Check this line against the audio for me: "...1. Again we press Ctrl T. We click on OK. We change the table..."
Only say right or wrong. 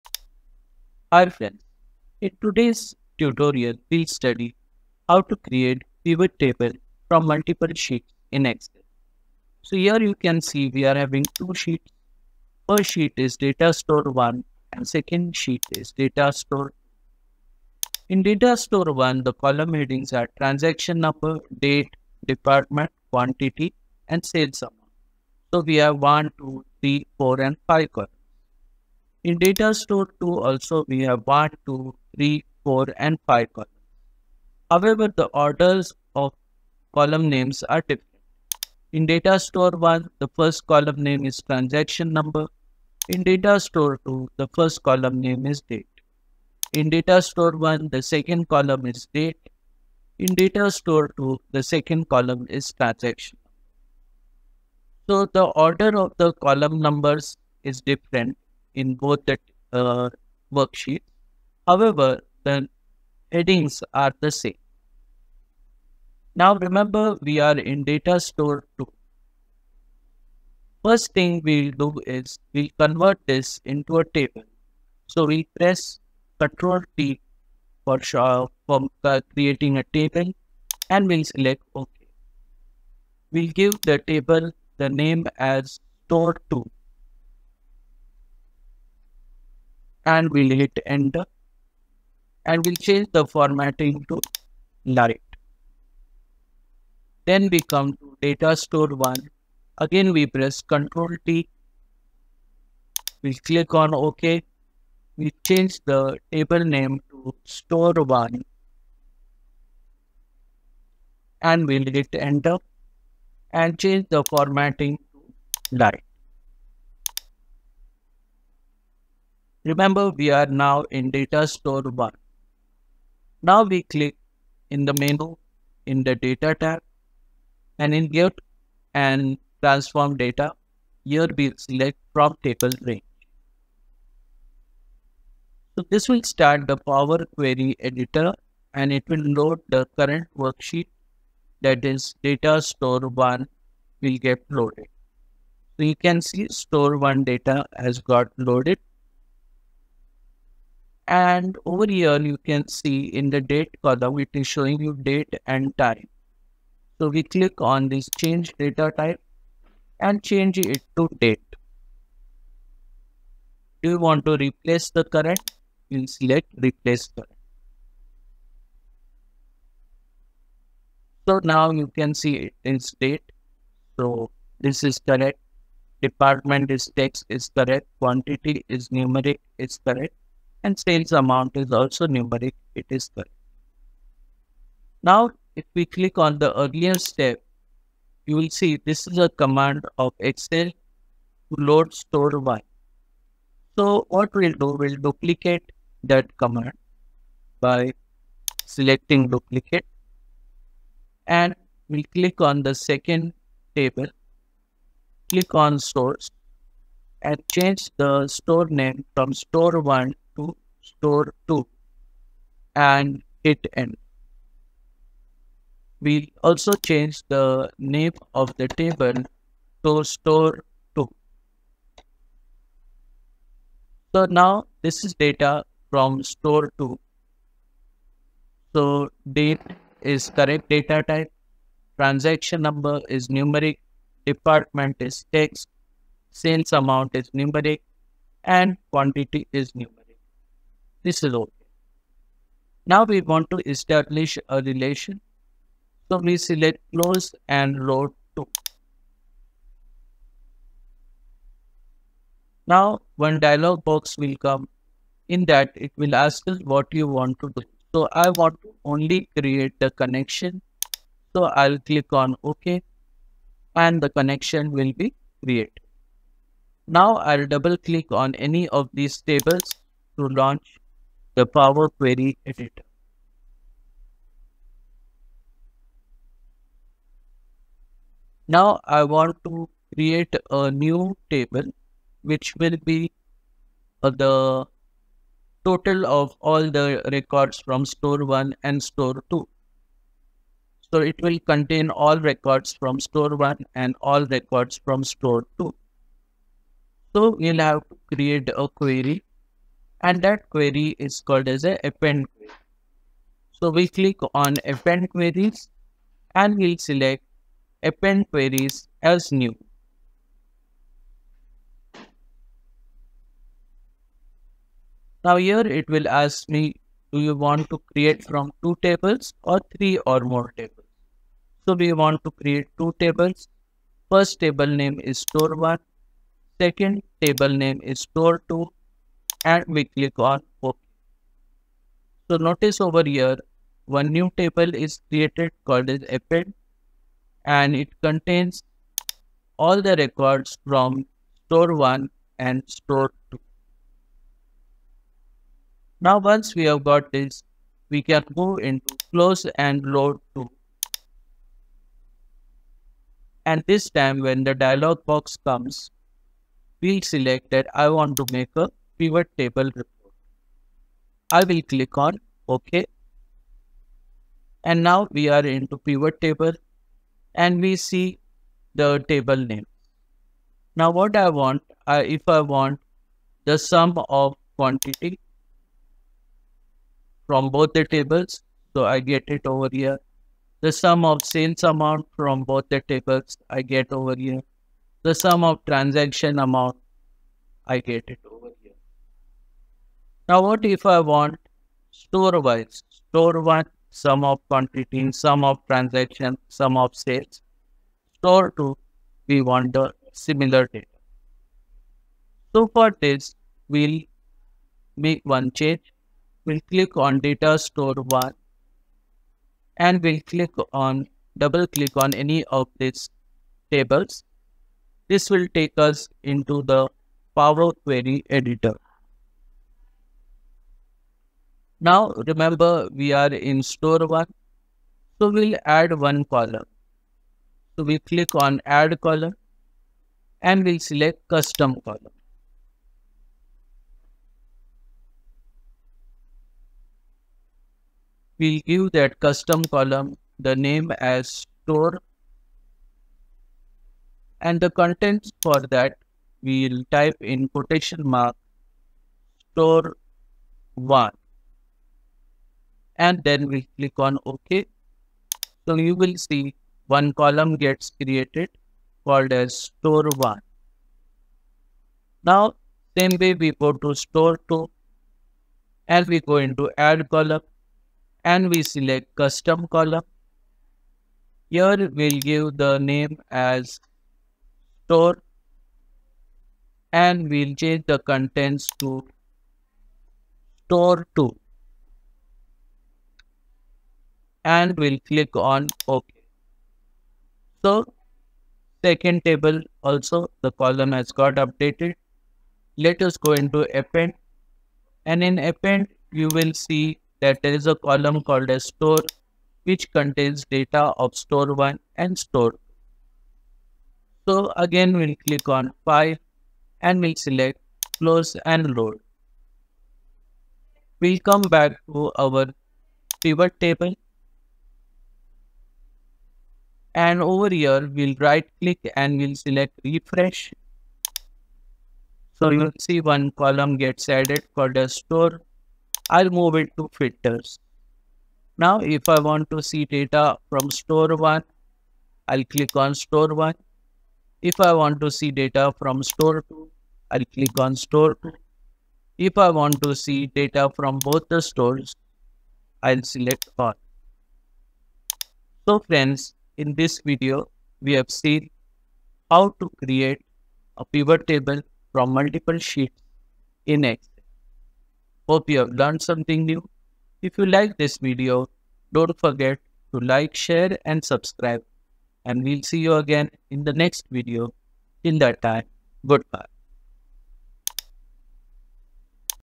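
right.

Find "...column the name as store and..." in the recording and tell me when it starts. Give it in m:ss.
7:19.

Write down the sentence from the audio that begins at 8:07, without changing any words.
So second table also the column has got updated.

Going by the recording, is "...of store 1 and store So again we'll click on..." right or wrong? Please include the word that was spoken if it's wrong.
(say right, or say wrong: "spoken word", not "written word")
right.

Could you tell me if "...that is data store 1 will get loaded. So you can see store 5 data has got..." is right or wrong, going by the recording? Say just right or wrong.
wrong.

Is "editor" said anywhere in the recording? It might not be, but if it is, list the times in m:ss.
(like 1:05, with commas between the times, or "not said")
2:17, 4:32, 6:58.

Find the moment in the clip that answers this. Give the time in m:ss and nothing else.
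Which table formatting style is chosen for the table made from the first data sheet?
1:55.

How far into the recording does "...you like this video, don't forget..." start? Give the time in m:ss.
9:17.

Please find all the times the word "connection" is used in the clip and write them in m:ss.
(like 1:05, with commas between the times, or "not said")
4:19, 4:24.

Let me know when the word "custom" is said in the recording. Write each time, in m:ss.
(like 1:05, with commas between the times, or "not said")
7:11, 7:19, 7:49.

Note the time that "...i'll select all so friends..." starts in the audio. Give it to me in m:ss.
9:02.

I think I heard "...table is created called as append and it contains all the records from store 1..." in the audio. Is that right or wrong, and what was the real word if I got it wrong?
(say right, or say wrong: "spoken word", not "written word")
right.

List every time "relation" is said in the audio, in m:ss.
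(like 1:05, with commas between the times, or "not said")
4:04.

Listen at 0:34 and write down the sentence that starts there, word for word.
However, the orders of column names are different.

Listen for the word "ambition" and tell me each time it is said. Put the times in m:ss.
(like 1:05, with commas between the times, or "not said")
not said.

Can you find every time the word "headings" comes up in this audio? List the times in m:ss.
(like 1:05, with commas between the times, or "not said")
0:19, 1:03.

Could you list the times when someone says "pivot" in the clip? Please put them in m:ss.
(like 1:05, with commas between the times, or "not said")
0:06, 5:59, 6:05, 8:33, 9:10.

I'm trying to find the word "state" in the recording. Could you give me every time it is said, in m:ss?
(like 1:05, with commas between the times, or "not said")
2:52.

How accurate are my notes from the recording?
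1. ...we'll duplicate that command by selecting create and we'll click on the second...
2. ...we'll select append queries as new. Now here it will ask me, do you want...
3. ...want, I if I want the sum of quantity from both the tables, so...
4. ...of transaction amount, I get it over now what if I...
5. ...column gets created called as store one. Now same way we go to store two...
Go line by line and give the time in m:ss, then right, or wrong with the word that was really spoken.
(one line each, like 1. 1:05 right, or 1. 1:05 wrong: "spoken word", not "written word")
1. 3:14 wrong: "duplicate", not "create"
2. 5:06 right
3. 6:11 right
4. 6:25 right
5. 7:37 right.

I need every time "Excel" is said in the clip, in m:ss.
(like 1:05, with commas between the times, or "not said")
0:08, 3:10, 9:13.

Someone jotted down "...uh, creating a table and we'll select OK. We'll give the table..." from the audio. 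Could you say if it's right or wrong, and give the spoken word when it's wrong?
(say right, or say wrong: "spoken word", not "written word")
right.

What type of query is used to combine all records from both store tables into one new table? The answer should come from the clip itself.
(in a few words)
Append query.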